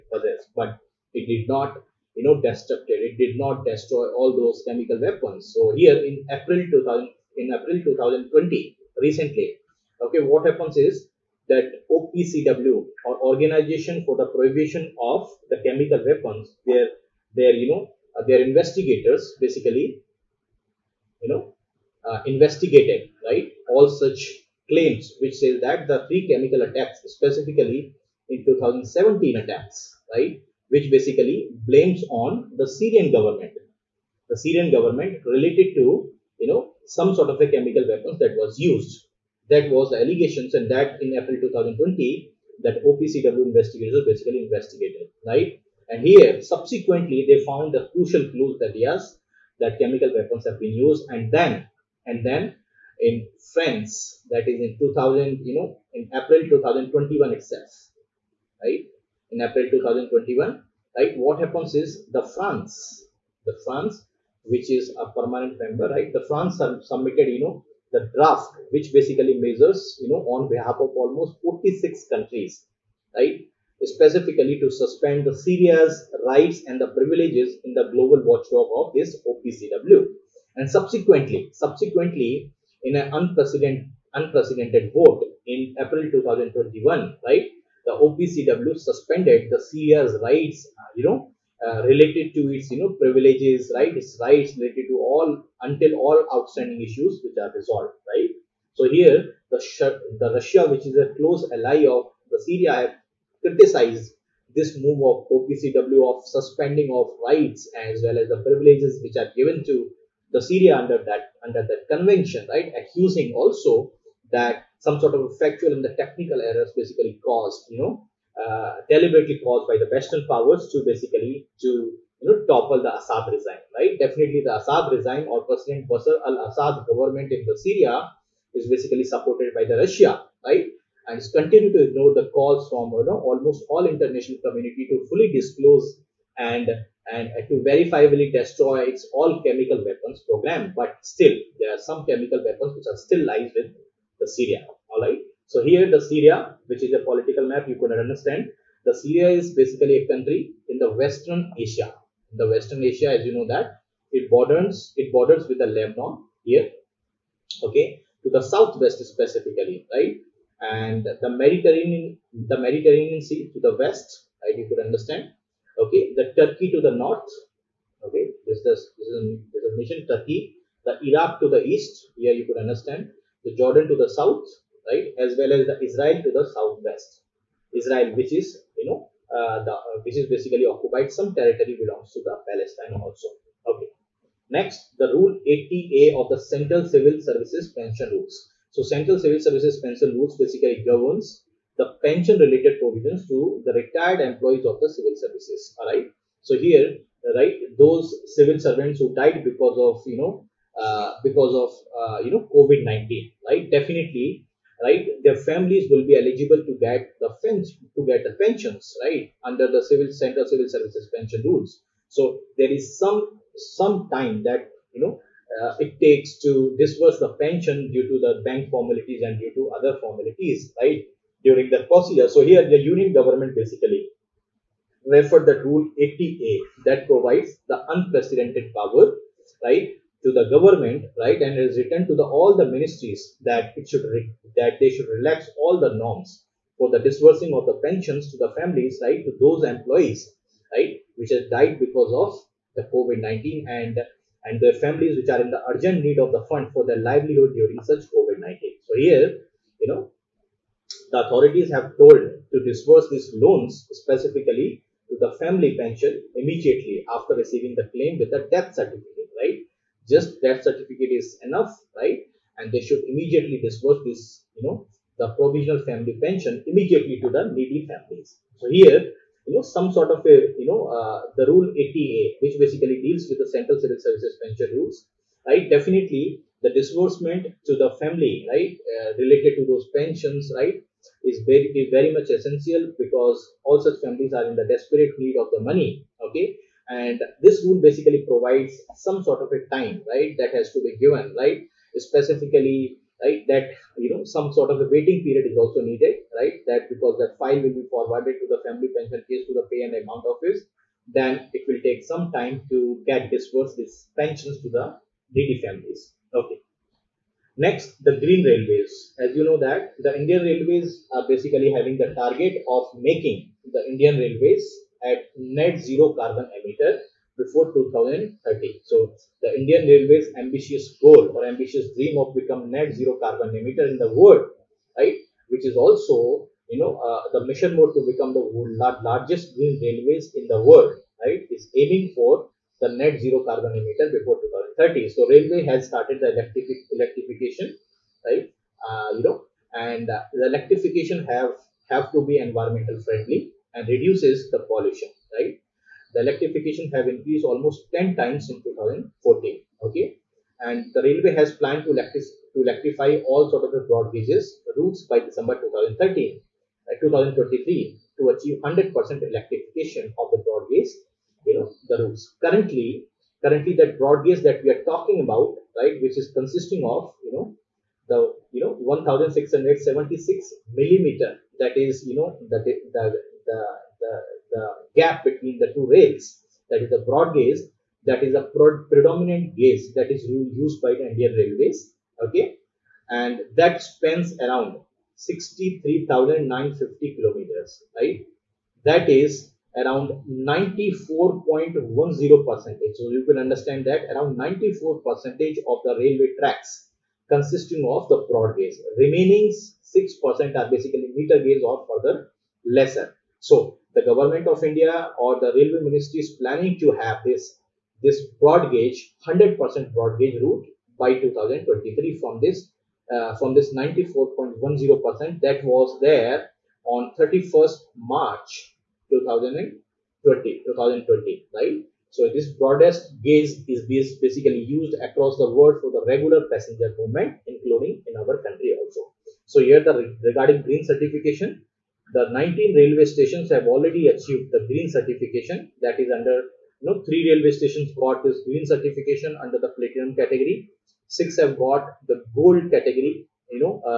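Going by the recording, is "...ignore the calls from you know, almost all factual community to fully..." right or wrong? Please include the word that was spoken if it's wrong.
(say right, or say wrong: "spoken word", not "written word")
wrong: "international", not "factual".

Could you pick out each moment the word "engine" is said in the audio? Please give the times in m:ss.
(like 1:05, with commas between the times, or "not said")
not said.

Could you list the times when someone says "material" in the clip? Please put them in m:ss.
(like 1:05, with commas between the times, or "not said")
not said.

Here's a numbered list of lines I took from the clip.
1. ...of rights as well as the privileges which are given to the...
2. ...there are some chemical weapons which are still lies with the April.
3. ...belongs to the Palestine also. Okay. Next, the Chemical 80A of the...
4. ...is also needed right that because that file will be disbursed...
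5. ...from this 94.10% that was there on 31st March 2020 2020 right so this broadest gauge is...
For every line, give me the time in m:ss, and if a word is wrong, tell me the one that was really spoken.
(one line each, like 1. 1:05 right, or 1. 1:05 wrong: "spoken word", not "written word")
1. 1:46 right
2. 2:21 wrong: "Syria", not "April"
3. 3:01 wrong: "Rule", not "Chemical"
4. 4:55 wrong: "forwarded", not "disbursed"
5. 6:53 right.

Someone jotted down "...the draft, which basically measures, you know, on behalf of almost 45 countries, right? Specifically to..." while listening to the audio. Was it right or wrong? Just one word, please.
wrong.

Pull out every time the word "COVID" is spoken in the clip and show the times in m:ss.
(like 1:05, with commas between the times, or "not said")
3:22, 4:02, 4:08.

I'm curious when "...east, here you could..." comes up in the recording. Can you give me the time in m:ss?
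2:51.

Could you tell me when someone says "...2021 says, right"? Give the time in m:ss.
0:56.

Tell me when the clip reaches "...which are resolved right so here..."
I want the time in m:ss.
1:37.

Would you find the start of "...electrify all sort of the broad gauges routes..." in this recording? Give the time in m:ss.
5:52.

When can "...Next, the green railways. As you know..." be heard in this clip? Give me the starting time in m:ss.
5:07.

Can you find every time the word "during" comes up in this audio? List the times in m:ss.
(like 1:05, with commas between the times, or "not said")
3:41, 4:07.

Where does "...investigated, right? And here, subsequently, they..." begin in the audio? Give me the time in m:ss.
0:44.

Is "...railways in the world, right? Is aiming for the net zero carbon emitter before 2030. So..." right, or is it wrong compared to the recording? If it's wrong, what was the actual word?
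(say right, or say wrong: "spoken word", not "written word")
right.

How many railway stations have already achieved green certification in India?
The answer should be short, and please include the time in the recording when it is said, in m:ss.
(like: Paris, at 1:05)
19, at 7:12.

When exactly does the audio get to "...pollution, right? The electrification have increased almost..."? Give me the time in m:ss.
5:44.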